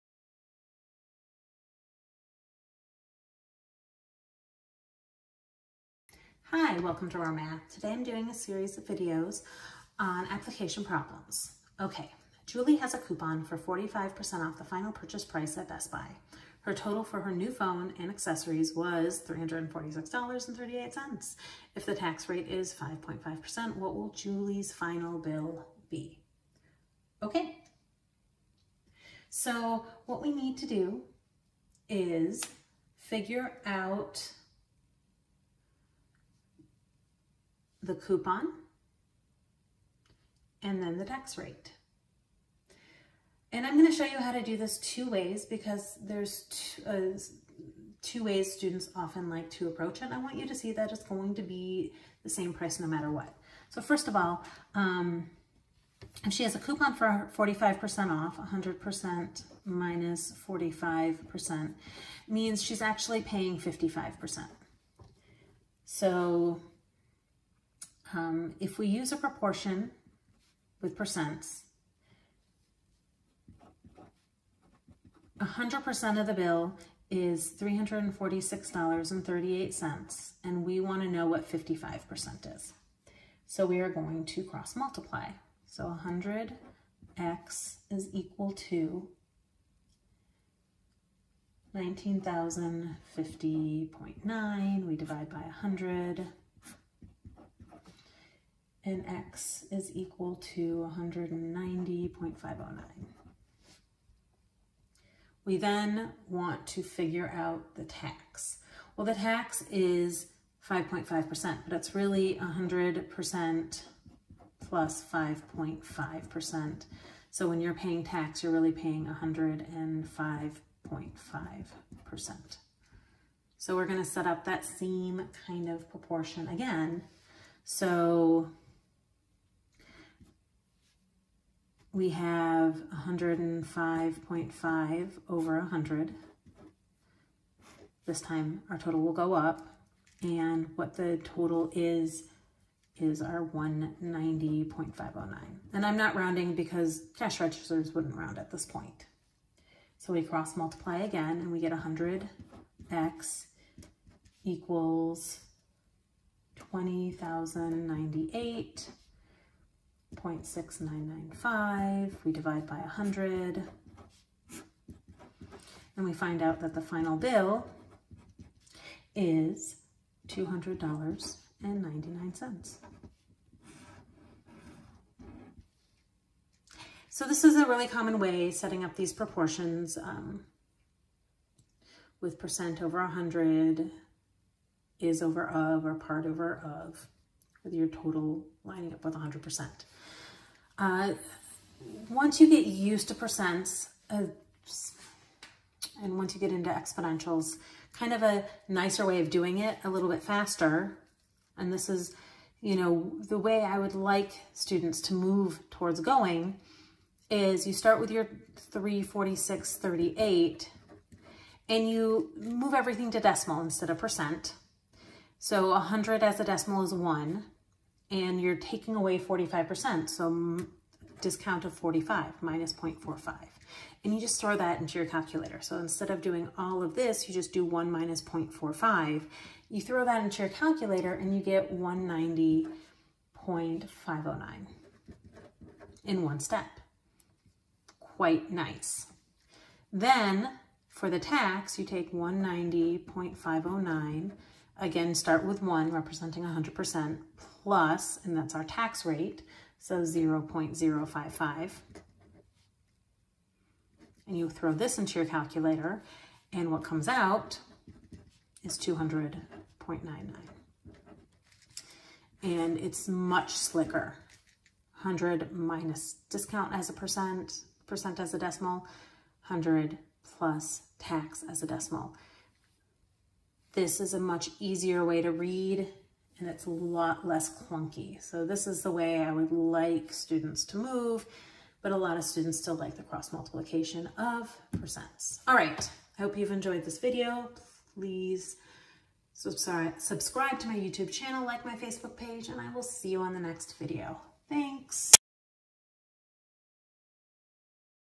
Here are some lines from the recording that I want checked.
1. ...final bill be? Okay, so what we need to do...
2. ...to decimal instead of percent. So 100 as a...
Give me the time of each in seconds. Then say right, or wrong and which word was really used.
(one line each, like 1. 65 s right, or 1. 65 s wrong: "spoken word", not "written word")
1. 24 s right
2. 213 s right.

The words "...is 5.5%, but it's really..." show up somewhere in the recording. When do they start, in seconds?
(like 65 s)
109 s.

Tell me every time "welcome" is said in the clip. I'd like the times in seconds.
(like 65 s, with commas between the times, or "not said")
6 s.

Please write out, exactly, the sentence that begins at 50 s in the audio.
I want you to see that it's going to be the same price no matter what.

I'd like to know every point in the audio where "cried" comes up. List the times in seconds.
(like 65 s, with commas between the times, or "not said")
not said.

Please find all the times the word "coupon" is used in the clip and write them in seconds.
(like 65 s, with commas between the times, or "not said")
12 s, 37 s, 56 s.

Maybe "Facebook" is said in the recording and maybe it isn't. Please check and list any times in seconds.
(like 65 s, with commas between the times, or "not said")
291 s.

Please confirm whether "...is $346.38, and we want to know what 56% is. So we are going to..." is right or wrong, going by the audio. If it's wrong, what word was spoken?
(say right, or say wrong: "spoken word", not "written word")
wrong: "55", not "56".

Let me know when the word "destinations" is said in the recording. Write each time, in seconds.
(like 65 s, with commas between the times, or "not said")
not said.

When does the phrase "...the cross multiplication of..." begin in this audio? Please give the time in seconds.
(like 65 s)
282 s.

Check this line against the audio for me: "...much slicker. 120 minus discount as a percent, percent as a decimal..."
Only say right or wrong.
wrong.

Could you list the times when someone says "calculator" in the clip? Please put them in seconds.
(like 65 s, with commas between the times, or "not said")
225 s, 230 s, 255 s.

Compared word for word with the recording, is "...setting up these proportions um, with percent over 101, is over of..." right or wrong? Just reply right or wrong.
wrong.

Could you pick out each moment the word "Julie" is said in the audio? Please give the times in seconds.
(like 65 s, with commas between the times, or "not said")
12 s, 24 s.